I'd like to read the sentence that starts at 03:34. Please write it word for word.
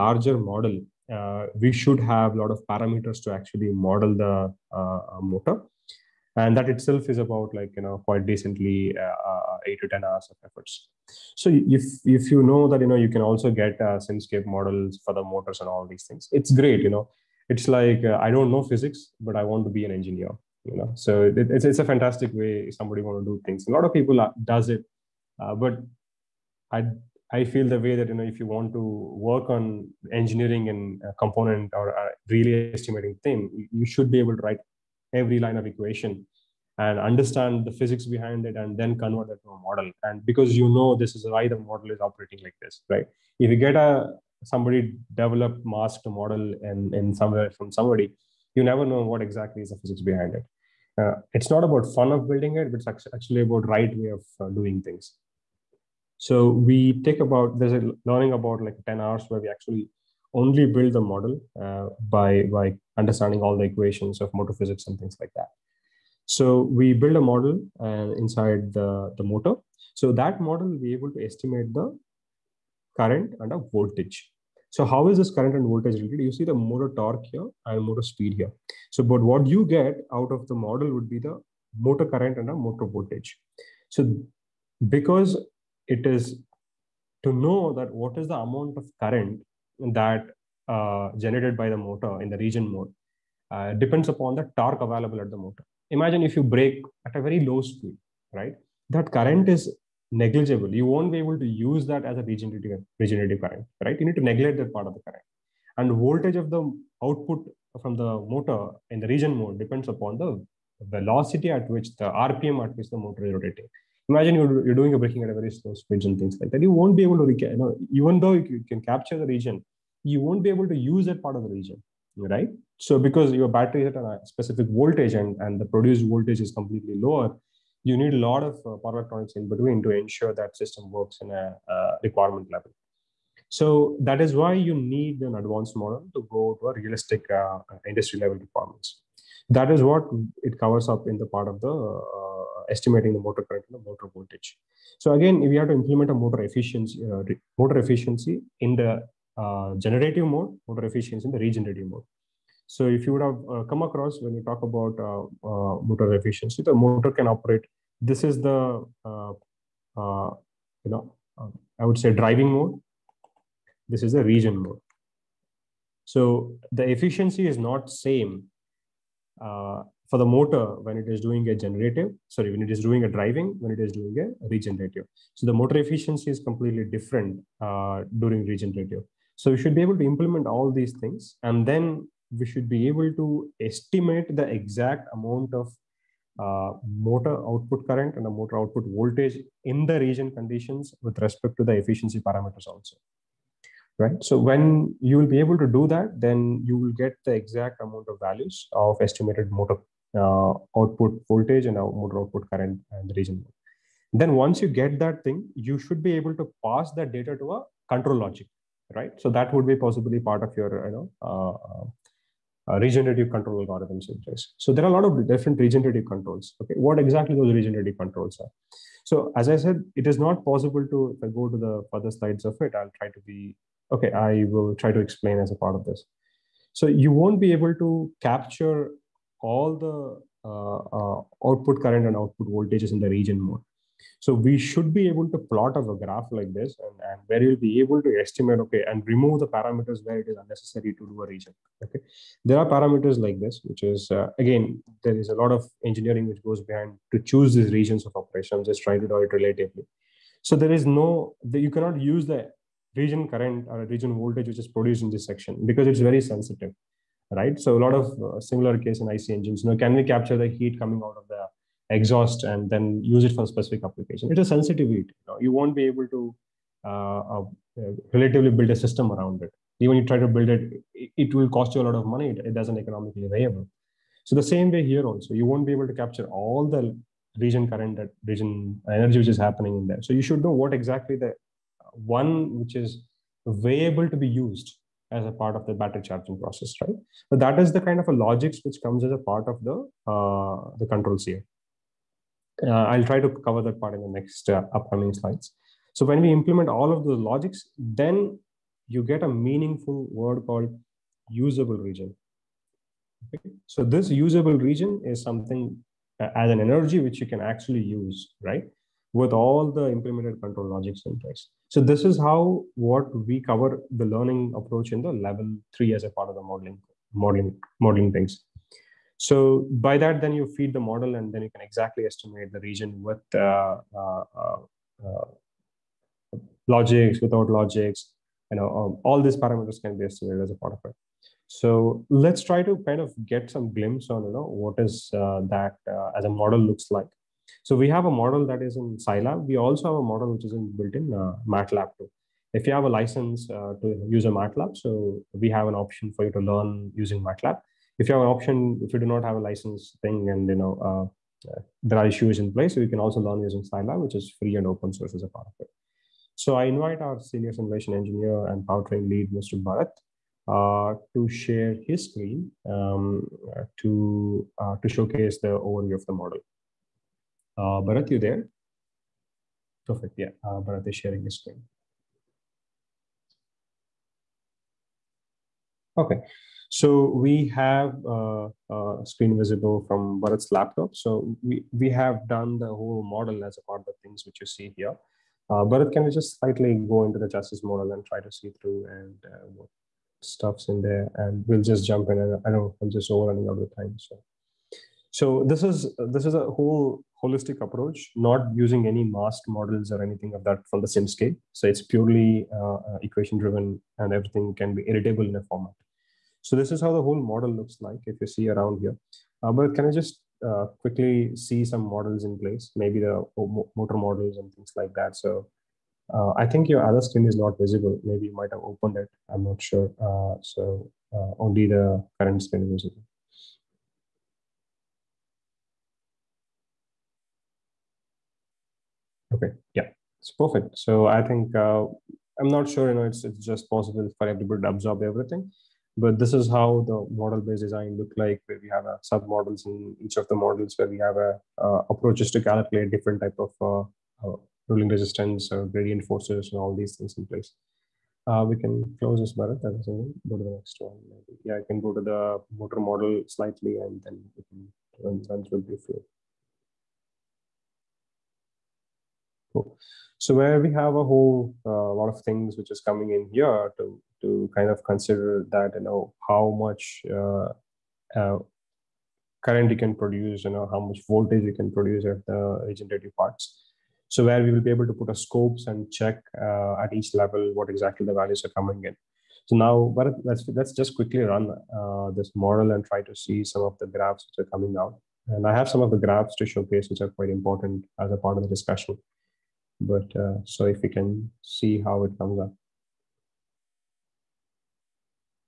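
So there are a lot of different regenerative controls.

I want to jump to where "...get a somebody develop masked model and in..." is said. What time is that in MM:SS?
00:43.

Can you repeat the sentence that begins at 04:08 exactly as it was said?
I'm just trying to do it relatively.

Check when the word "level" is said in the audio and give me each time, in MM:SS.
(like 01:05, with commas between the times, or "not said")
02:12, 02:18, 05:15, 07:57.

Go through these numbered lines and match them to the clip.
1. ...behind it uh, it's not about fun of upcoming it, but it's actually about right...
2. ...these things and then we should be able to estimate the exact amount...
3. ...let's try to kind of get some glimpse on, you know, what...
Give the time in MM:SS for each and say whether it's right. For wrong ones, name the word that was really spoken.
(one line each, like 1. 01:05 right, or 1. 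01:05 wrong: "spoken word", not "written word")
1. 00:50 wrong: "building", not "upcoming"
2. 03:00 right
3. 05:32 right.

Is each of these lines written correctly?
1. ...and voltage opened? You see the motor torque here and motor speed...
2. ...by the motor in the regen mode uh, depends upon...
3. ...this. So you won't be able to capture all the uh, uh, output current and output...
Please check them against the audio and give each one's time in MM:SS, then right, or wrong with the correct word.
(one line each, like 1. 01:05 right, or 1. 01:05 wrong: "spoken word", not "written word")
1. 01:15 wrong: "related", not "opened"
2. 01:31 right
3. 03:45 right.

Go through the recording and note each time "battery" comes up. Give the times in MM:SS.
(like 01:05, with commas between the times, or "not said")
02:03, 04:45.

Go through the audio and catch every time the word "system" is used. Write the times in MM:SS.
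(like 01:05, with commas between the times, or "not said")
02:10, 04:28.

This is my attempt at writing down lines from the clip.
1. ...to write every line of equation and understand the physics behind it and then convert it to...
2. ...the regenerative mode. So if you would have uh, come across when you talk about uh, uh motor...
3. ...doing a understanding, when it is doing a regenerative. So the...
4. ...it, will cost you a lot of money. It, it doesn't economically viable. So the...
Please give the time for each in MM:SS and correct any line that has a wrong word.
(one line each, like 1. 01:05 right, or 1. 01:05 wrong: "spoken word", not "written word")
1. 00:34 right
2. 02:31 right
3. 02:52 wrong: "driving", not "understanding"
4. 04:30 right.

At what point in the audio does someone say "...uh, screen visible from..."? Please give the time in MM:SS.
06:18.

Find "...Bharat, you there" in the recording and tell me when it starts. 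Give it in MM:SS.
06:07.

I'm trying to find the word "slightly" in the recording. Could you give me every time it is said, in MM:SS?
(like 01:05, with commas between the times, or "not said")
06:26, 07:33.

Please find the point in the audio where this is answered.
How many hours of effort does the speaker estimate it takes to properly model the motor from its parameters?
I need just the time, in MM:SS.
00:09.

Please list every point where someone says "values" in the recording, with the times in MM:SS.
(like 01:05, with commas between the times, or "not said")
03:18, 07:58.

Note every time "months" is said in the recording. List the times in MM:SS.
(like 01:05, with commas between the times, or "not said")
not said.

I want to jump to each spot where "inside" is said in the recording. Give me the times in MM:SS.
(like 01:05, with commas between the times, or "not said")
01:08.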